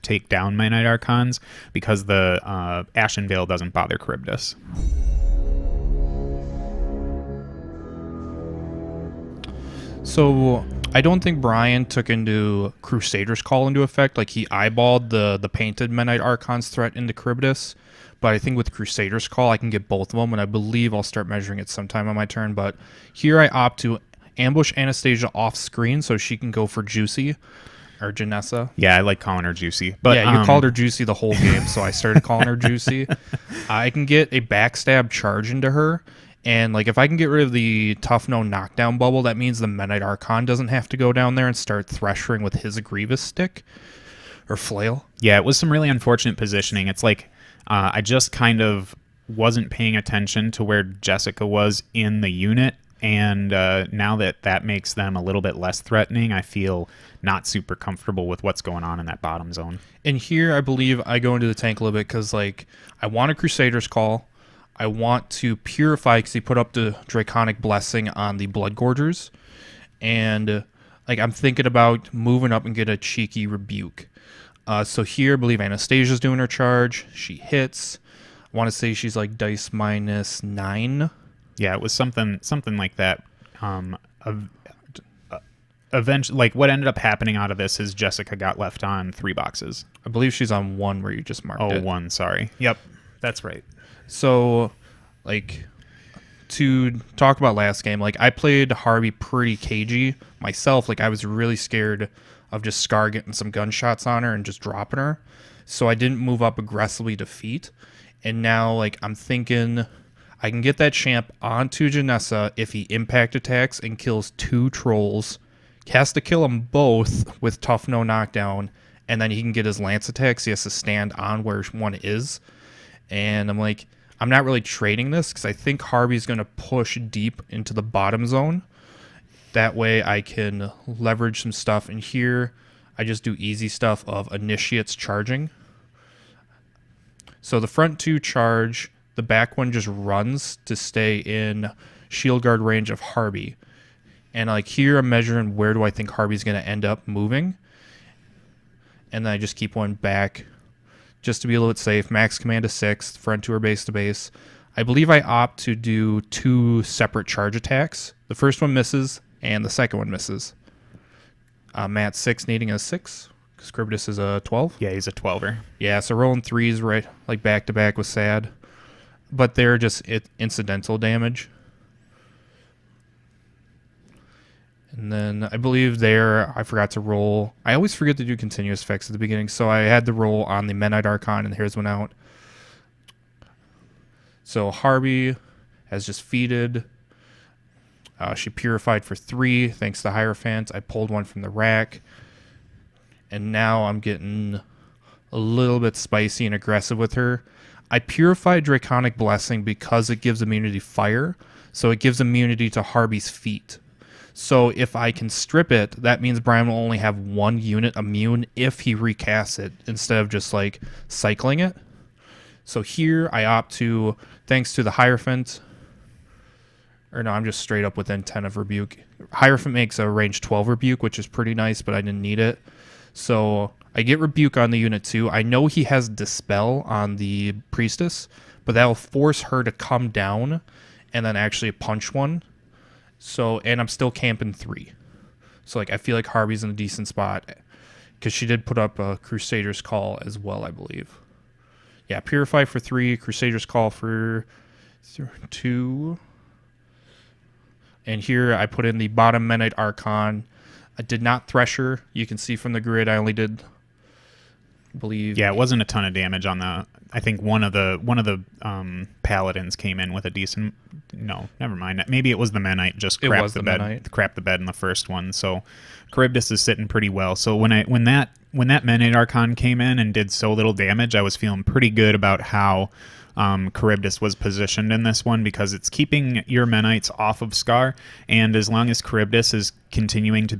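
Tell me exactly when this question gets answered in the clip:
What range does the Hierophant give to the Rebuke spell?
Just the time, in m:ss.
3:40.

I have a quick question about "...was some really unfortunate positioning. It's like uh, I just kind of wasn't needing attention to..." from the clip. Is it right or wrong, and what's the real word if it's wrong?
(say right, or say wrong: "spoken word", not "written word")
wrong: "paying", not "needing".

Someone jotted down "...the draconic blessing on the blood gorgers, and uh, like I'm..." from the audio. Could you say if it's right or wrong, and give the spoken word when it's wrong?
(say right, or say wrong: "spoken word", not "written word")
right.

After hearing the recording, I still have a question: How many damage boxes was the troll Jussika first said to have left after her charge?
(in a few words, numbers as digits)
3.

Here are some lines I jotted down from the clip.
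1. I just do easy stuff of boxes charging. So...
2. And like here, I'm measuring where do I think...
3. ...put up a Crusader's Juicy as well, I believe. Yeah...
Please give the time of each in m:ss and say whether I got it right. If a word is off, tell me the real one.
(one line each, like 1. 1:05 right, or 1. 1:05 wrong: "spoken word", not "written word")
1. 2:12 wrong: "initiates", not "boxes"
2. 2:24 right
3. 3:58 wrong: "Call", not "Juicy".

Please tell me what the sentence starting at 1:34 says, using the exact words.
So, like, to talk about last game, like I played Harby pretty cagey myself.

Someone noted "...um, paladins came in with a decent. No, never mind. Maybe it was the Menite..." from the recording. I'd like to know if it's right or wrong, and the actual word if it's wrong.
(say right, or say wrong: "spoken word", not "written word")
right.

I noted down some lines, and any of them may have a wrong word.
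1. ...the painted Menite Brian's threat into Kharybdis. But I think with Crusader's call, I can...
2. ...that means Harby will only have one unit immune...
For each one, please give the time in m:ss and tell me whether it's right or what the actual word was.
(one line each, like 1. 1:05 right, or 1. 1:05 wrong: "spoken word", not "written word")
1. 0:15 wrong: "Archon", not "Brian"
2. 3:25 wrong: "Brian", not "Harby".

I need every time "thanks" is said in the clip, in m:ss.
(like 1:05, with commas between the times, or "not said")
3:09, 3:34.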